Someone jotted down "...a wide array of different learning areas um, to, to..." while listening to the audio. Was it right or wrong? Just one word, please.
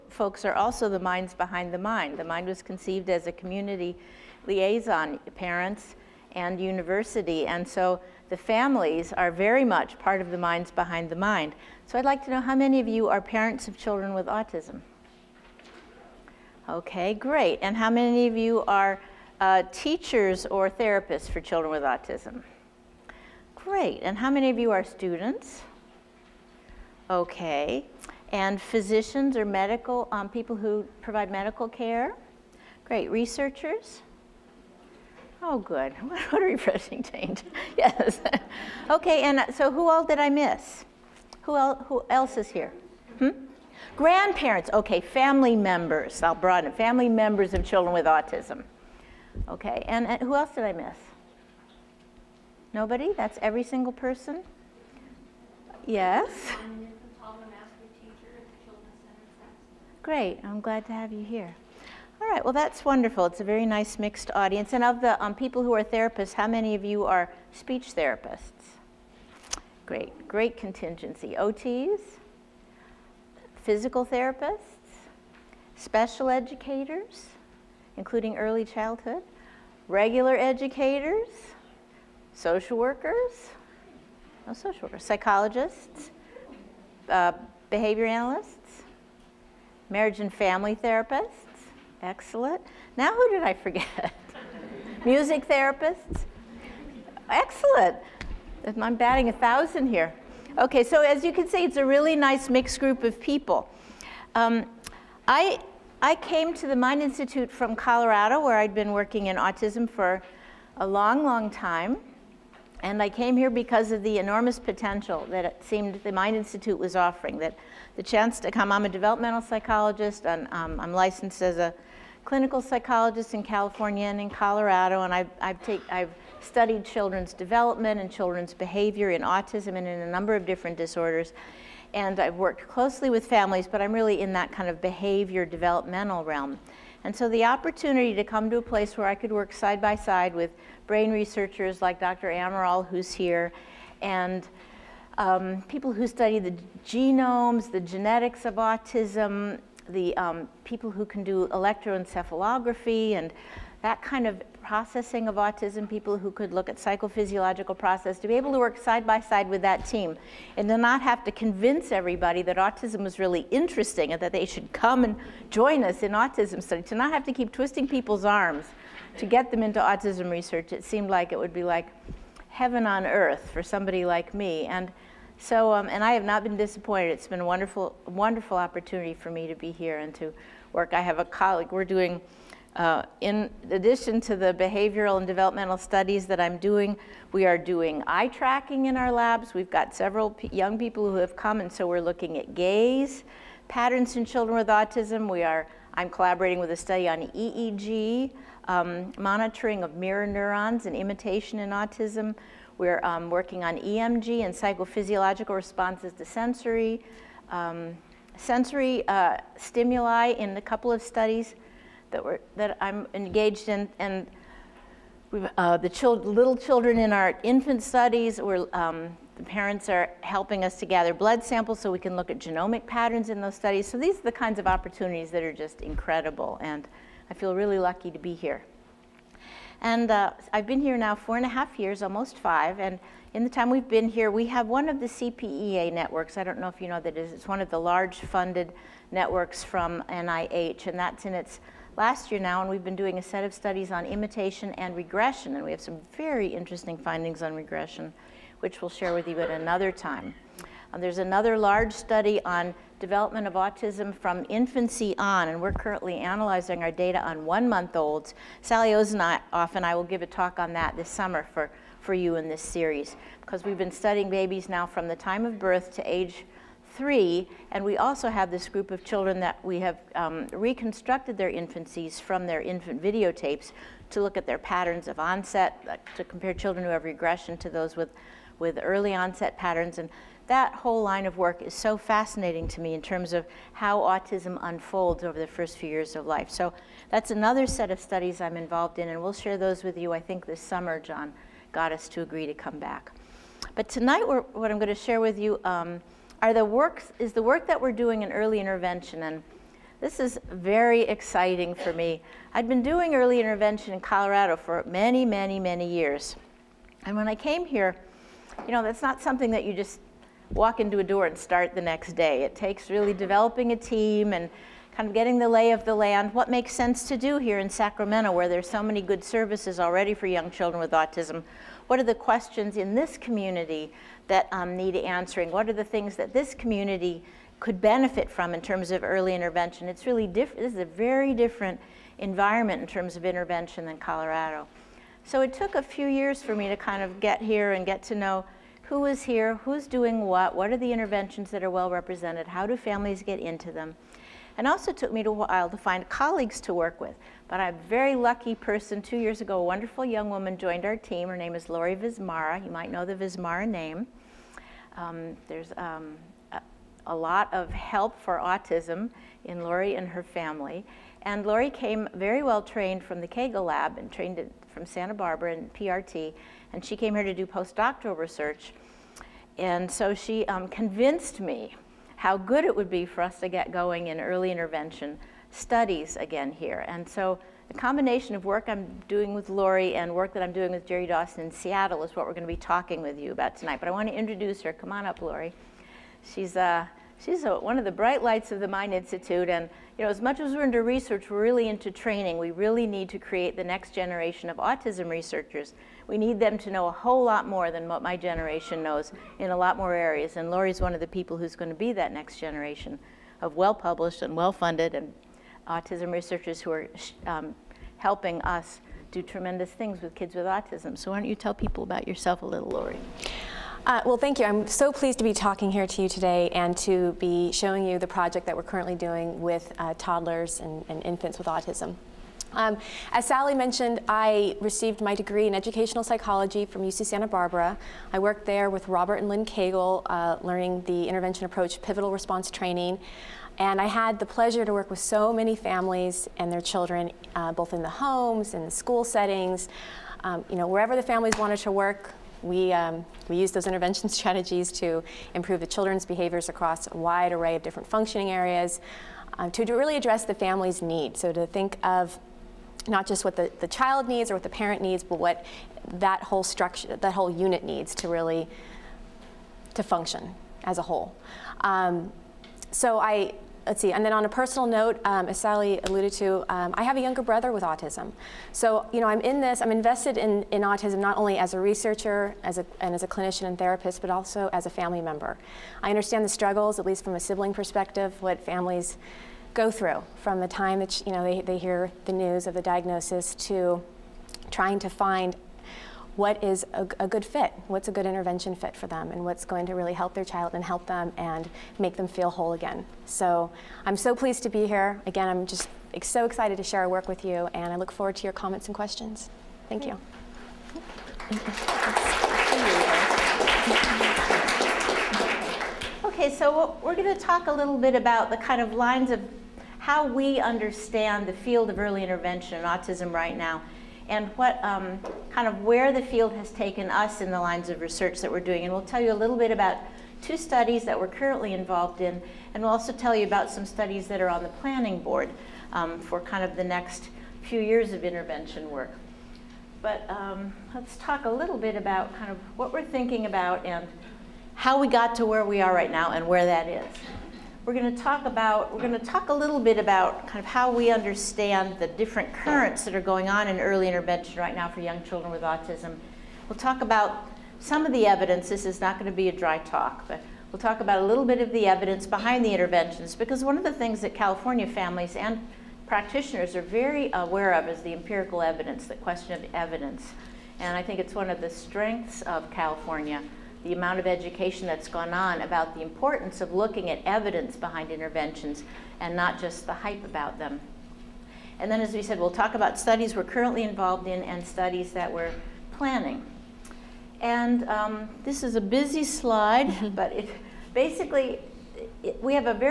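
wrong.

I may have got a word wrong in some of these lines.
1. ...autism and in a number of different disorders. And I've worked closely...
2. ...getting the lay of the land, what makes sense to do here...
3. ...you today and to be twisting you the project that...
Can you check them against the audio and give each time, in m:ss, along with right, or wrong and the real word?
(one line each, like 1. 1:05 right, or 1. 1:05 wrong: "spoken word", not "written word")
1. 2:09 right
2. 5:15 right
3. 6:56 wrong: "showing", not "twisting".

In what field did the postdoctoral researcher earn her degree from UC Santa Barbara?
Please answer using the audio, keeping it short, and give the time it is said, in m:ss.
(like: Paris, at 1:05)
educational psychology, at 7:05.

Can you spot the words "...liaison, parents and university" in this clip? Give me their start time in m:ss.
0:04.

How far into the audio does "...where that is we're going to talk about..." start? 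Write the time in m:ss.
8:56.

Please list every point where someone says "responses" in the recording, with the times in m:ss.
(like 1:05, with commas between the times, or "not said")
3:25, 7:12.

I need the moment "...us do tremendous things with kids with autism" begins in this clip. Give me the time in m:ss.
6:48.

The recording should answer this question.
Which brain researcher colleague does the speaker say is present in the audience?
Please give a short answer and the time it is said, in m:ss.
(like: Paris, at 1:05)
Dr. Amaral, at 2:21.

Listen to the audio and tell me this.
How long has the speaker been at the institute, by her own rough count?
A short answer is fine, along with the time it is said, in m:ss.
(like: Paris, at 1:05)
four and a half years, at 3:51.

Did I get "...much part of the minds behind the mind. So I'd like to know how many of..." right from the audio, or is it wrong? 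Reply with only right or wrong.
right.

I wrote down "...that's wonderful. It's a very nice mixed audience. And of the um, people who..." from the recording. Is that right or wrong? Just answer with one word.
right.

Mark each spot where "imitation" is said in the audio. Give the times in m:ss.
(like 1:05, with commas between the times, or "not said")
3:20, 4:04.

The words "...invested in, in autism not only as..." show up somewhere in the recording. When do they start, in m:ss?
7:49.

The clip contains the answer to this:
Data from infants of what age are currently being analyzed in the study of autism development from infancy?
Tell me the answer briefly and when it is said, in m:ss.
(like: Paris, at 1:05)
one-month-olds, at 4:17.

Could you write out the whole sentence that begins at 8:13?
So I'm so pleased to be here.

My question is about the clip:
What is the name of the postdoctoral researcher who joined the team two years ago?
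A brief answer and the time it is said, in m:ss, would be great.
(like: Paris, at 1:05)
Laurie Vismara, at 5:51.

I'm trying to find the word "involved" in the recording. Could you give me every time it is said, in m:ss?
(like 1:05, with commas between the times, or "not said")
4:48, 8:41, 9:33.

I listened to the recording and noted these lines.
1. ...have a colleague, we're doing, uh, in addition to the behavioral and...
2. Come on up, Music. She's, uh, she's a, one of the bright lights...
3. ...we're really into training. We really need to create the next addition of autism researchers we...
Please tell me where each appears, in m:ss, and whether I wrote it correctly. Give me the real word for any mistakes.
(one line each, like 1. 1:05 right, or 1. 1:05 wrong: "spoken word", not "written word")
1. 3:00 right
2. 6:24 wrong: "Laurie", not "Music"
3. 6:31 wrong: "generation", not "addition".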